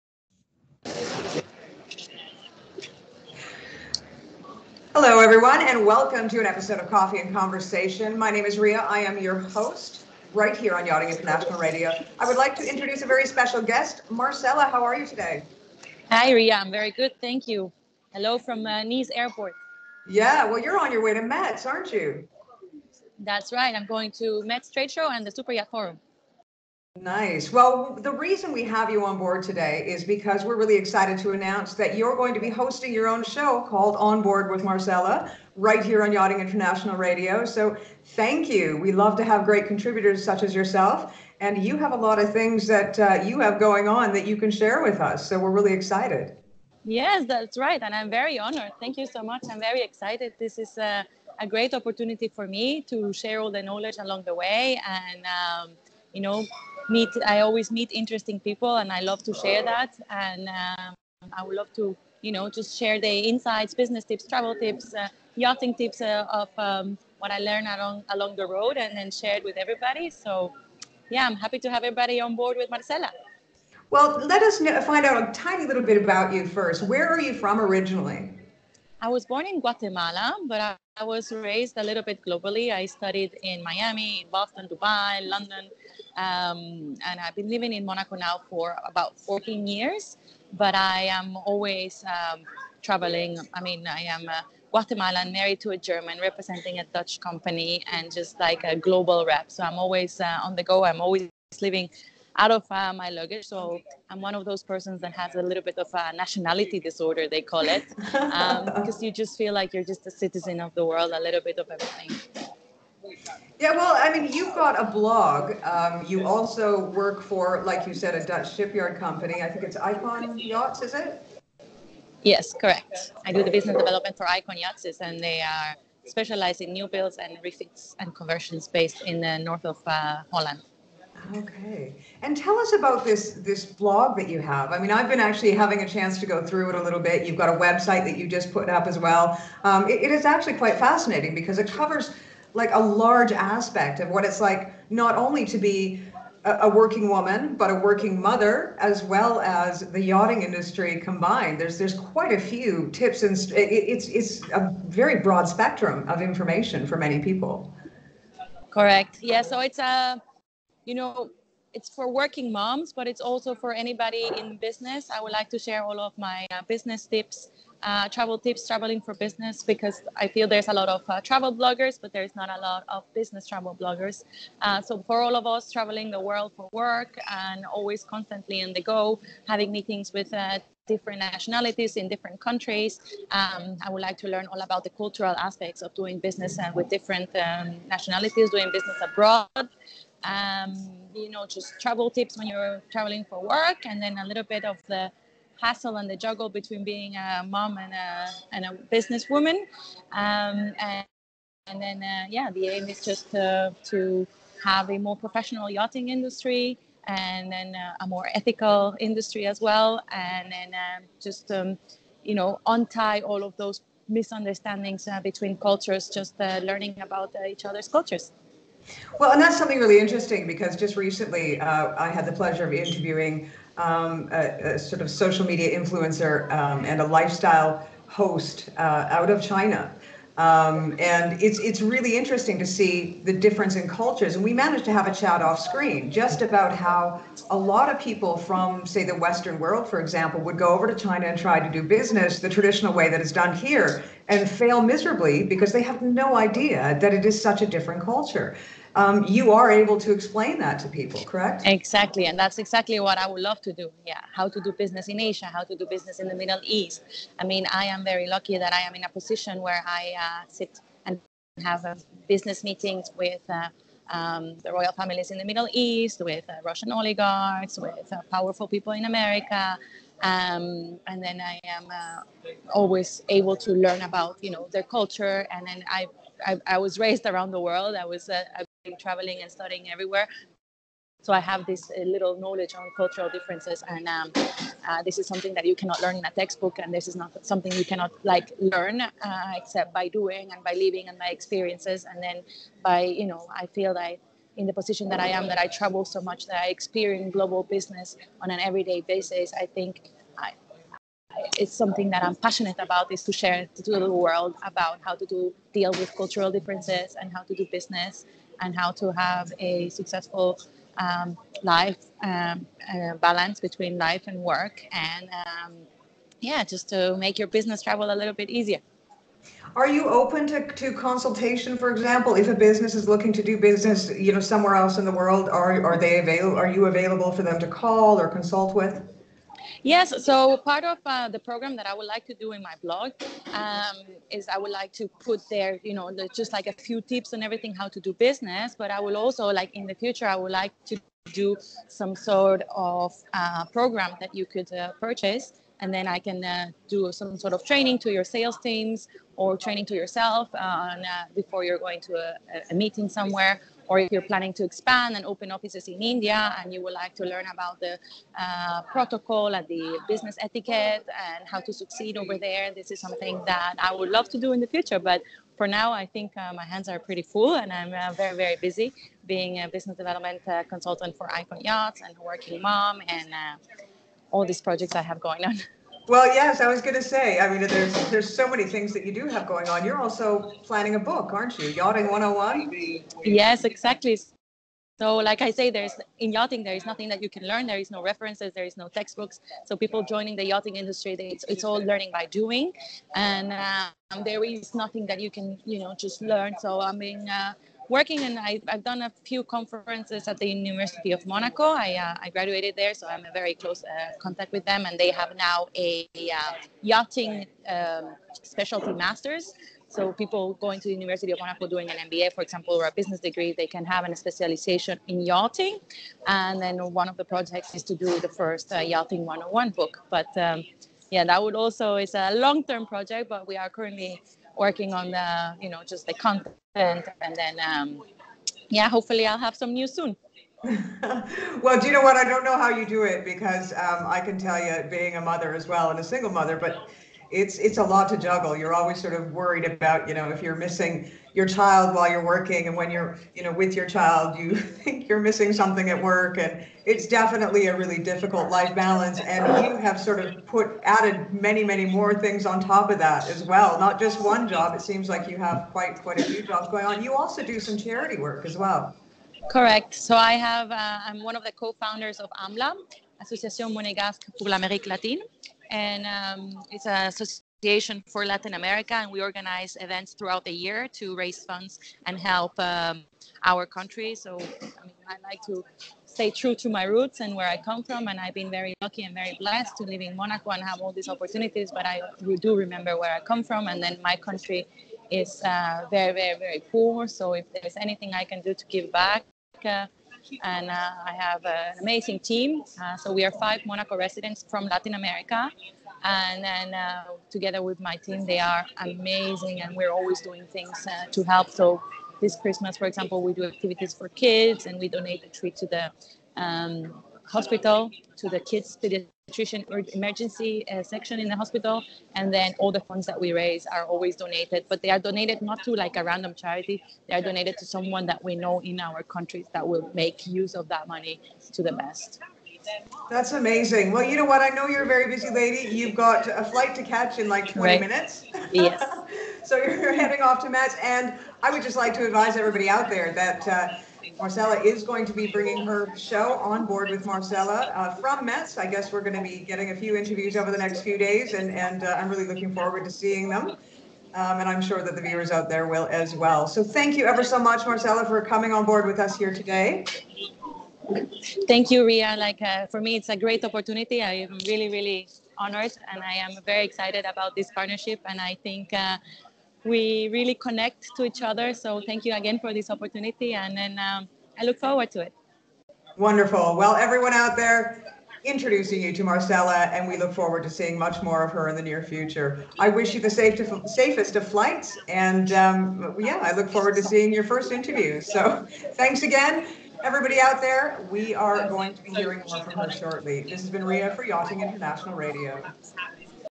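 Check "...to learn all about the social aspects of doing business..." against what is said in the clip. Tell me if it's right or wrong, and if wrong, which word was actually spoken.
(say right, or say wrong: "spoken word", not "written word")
wrong: "cultural", not "social".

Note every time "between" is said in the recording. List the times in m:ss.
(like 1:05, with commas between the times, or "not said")
3:16, 3:35, 5:13.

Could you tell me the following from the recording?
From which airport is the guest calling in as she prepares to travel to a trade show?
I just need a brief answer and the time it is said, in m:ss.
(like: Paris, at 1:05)
Nice Airport, at 0:18.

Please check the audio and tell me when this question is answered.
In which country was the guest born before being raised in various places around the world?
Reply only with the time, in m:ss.
1:19.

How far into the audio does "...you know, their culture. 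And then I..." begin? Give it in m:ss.
4:34.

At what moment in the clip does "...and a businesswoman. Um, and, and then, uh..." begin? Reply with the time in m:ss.
3:18.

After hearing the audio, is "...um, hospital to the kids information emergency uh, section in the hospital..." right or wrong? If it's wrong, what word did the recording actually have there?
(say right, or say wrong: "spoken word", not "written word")
wrong: "nutrition", not "information".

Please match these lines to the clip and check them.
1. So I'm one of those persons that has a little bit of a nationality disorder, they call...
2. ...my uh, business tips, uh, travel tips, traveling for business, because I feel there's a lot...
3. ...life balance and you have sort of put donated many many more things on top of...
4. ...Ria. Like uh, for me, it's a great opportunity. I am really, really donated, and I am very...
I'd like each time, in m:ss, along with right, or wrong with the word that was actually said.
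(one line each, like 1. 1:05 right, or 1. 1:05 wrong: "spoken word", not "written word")
1. 1:43 right
2. 2:46 right
3. 7:28 wrong: "added", not "donated"
4. 9:11 wrong: "honored", not "donated".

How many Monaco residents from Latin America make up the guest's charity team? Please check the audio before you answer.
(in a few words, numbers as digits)
5.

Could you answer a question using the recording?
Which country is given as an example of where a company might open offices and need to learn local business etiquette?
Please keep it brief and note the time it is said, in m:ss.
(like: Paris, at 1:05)
India, at 5:56.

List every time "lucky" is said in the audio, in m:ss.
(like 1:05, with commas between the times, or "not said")
4:18, 7:58.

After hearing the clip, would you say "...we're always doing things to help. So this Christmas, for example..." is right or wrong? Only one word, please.
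right.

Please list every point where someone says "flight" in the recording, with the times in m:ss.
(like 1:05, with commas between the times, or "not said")
8:46, 9:34.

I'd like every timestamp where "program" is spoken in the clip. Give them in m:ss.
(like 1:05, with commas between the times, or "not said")
5:31, 5:43.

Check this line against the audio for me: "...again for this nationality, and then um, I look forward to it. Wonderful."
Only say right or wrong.
wrong.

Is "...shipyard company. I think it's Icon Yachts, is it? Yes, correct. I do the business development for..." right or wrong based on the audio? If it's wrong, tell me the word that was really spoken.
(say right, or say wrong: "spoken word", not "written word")
right.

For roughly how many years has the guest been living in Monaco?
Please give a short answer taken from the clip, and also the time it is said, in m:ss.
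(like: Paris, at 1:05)
14, at 1:29.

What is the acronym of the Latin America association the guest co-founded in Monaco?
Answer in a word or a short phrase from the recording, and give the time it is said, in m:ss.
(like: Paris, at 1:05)
AMLA, at 7:42.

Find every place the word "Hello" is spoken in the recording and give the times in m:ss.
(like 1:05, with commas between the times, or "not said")
0:05, 0:18.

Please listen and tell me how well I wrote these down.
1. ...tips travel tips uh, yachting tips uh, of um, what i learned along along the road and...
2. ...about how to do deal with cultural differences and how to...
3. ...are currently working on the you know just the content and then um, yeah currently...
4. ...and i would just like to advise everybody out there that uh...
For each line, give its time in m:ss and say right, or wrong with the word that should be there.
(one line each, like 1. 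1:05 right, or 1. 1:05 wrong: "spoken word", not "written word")
1. 1:04 right
2. 5:04 right
3. 7:03 wrong: "hopefully", not "currently"
4. 8:50 right.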